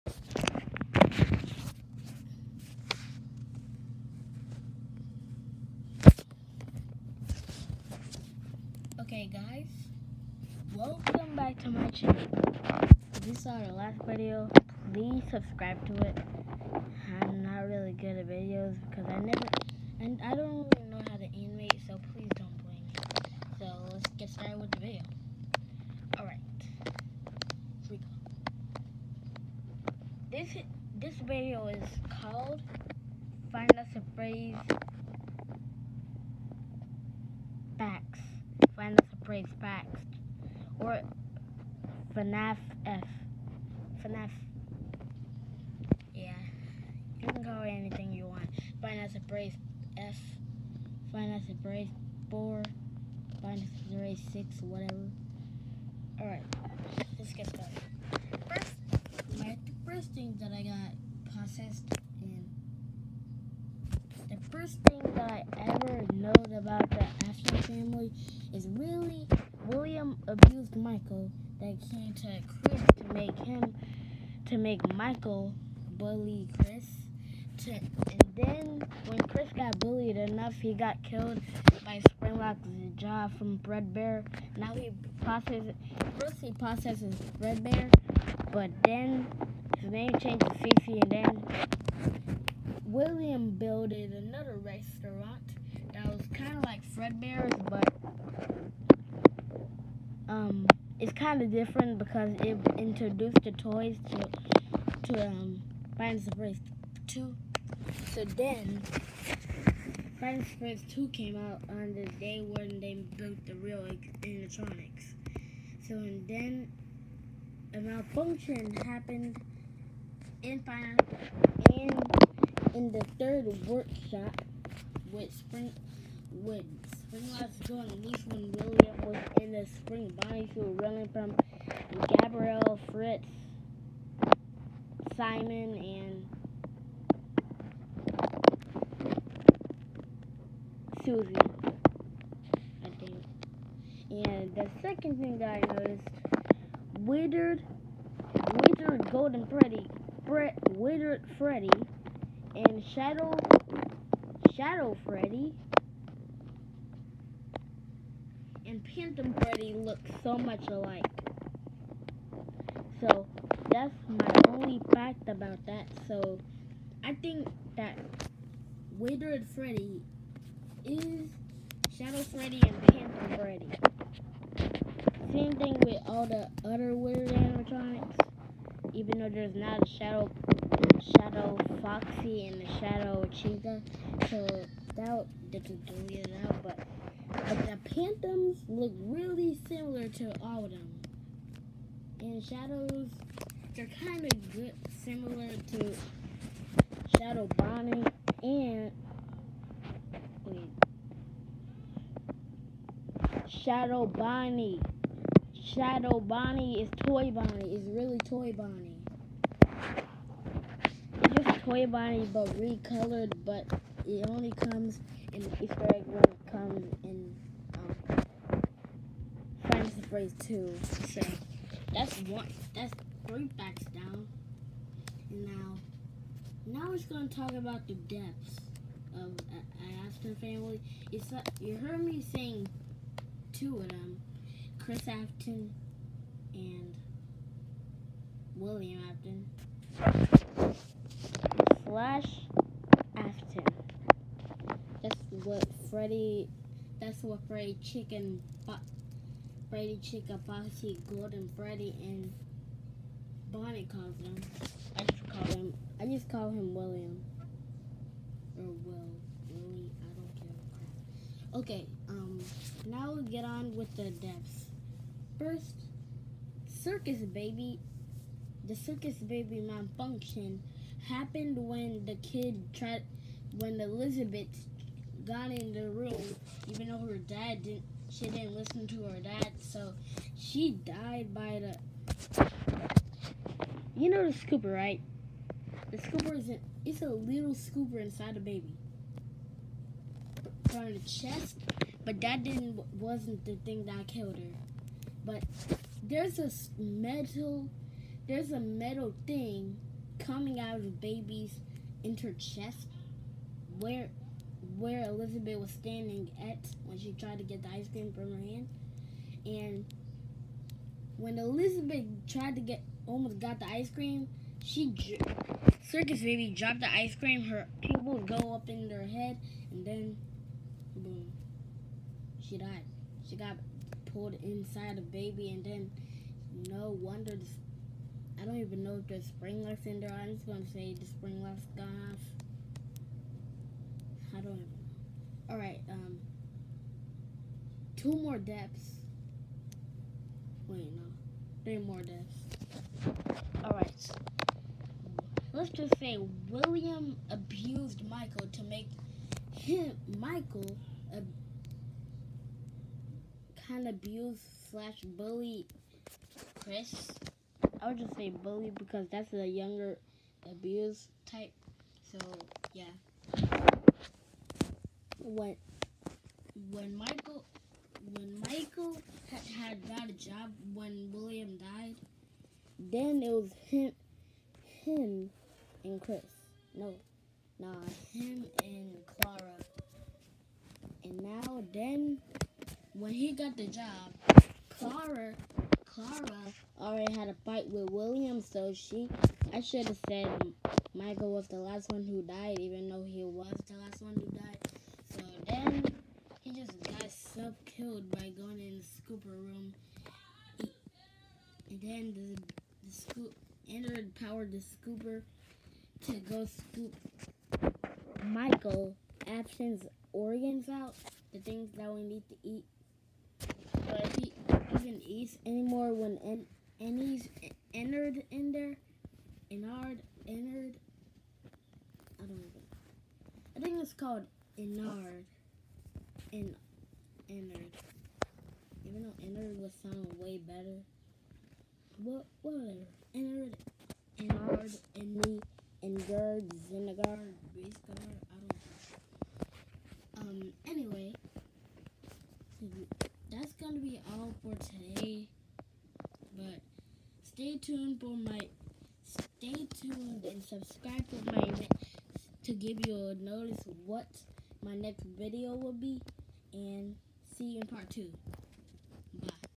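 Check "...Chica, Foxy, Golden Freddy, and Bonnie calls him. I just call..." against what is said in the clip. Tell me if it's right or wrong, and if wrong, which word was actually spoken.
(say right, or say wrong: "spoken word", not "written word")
right.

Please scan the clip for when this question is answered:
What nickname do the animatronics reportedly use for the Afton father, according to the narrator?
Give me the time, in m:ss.
4:01.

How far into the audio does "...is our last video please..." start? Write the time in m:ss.
0:13.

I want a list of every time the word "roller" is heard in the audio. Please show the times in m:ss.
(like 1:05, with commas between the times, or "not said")
not said.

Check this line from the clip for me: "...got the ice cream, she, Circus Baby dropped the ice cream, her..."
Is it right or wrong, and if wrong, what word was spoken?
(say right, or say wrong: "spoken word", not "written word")
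right.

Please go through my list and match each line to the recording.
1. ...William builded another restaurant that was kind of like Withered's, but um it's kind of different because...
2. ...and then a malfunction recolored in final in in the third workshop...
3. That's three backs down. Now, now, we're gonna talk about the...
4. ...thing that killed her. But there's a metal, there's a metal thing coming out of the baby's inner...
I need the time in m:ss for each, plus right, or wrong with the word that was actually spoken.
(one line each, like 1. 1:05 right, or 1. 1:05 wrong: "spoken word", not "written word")
1. 1:32 wrong: "Fredbear", not "Withered"
2. 1:55 wrong: "happened", not "recolored"
3. 3:42 right
4. 4:53 right.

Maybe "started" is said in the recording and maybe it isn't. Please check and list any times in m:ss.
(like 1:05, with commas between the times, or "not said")
0:24, 0:57.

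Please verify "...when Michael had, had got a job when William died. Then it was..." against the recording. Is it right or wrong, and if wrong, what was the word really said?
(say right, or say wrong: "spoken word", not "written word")
right.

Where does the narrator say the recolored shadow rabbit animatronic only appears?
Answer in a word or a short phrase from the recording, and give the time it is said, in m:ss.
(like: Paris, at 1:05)
the Easter egg room, at 3:35.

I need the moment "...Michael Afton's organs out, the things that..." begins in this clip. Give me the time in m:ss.
6:48.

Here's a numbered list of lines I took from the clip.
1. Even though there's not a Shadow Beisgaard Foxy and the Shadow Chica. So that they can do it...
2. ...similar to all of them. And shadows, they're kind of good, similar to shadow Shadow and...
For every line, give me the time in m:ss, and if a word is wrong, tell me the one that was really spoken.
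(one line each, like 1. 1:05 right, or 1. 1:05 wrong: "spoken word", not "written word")
1. 2:58 wrong: "Shadow", not "Beisgaard"
2. 3:09 wrong: "Bonnie", not "Shadow".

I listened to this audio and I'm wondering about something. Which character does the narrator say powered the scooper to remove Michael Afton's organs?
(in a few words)
the scoop Android.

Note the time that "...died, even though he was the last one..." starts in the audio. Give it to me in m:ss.
6:32.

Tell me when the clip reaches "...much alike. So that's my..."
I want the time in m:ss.
2:40.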